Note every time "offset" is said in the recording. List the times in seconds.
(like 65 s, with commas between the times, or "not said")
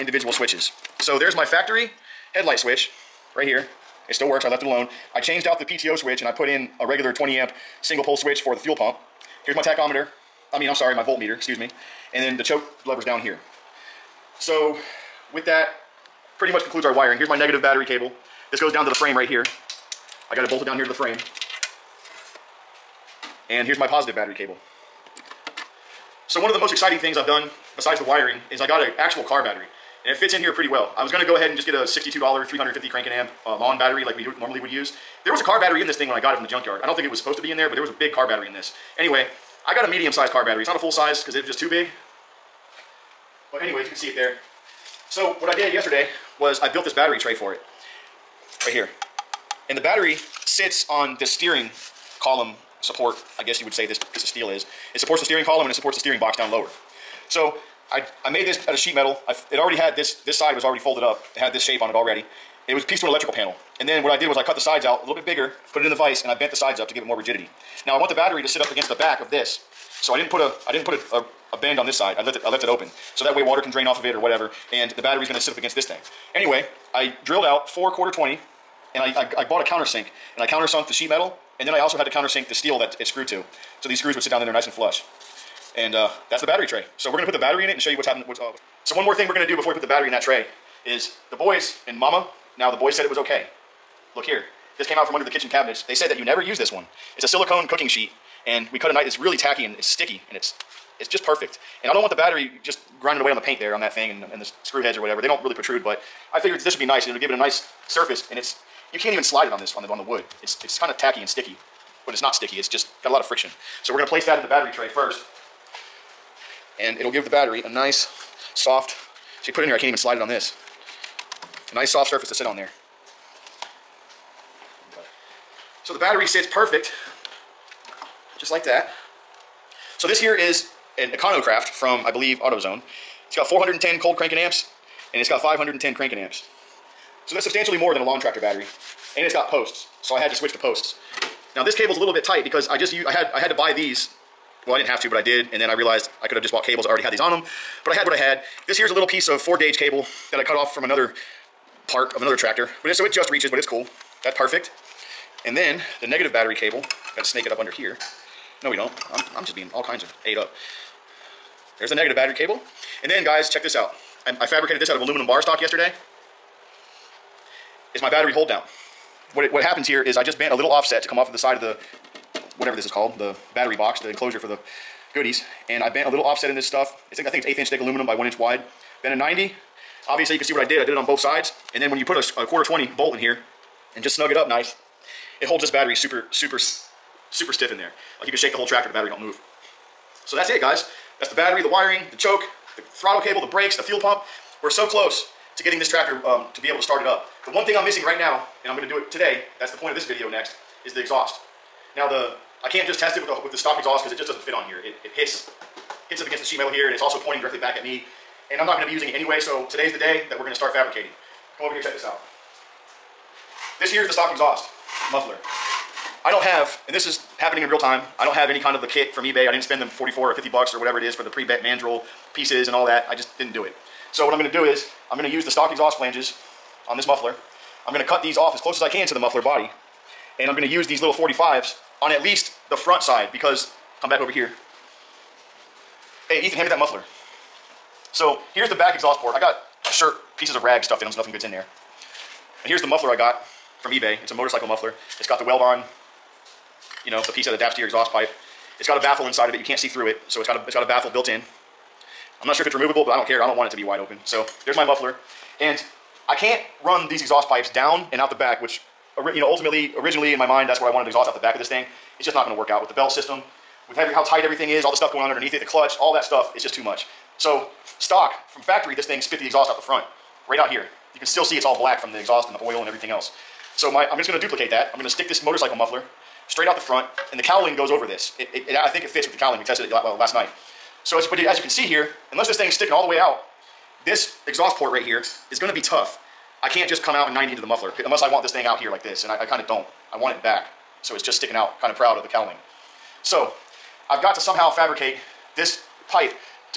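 170 s, 176 s.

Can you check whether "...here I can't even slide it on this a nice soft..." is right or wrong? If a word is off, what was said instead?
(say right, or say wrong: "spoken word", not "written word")
right.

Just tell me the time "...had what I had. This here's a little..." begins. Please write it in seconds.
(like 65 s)
147 s.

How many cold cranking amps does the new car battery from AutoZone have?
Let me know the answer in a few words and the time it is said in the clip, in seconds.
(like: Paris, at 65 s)
410, at 133 s.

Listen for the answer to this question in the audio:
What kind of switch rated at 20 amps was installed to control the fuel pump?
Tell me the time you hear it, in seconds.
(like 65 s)
7 s.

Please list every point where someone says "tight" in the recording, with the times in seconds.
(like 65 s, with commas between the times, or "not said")
142 s, 264 s.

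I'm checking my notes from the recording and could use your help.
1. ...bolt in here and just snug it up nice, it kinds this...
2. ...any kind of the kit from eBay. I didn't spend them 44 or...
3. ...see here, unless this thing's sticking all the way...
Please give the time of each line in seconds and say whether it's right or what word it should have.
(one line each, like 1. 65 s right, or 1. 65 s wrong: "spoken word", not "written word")
1. 182 s wrong: "holds", not "kinds"
2. 218 s right
3. 281 s right.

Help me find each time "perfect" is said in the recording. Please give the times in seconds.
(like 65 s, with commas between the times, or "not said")
101 s, 126 s, 154 s.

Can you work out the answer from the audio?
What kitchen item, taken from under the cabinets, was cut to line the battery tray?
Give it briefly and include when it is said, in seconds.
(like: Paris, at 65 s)
silicone cooking sheet, at 97 s.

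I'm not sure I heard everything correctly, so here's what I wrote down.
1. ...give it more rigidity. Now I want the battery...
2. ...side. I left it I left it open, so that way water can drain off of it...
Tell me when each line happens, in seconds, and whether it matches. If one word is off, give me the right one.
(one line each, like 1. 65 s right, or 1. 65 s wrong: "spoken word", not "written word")
1. 66 s right
2. 71 s right.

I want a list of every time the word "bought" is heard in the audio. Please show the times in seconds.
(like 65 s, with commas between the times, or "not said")
79 s, 146 s.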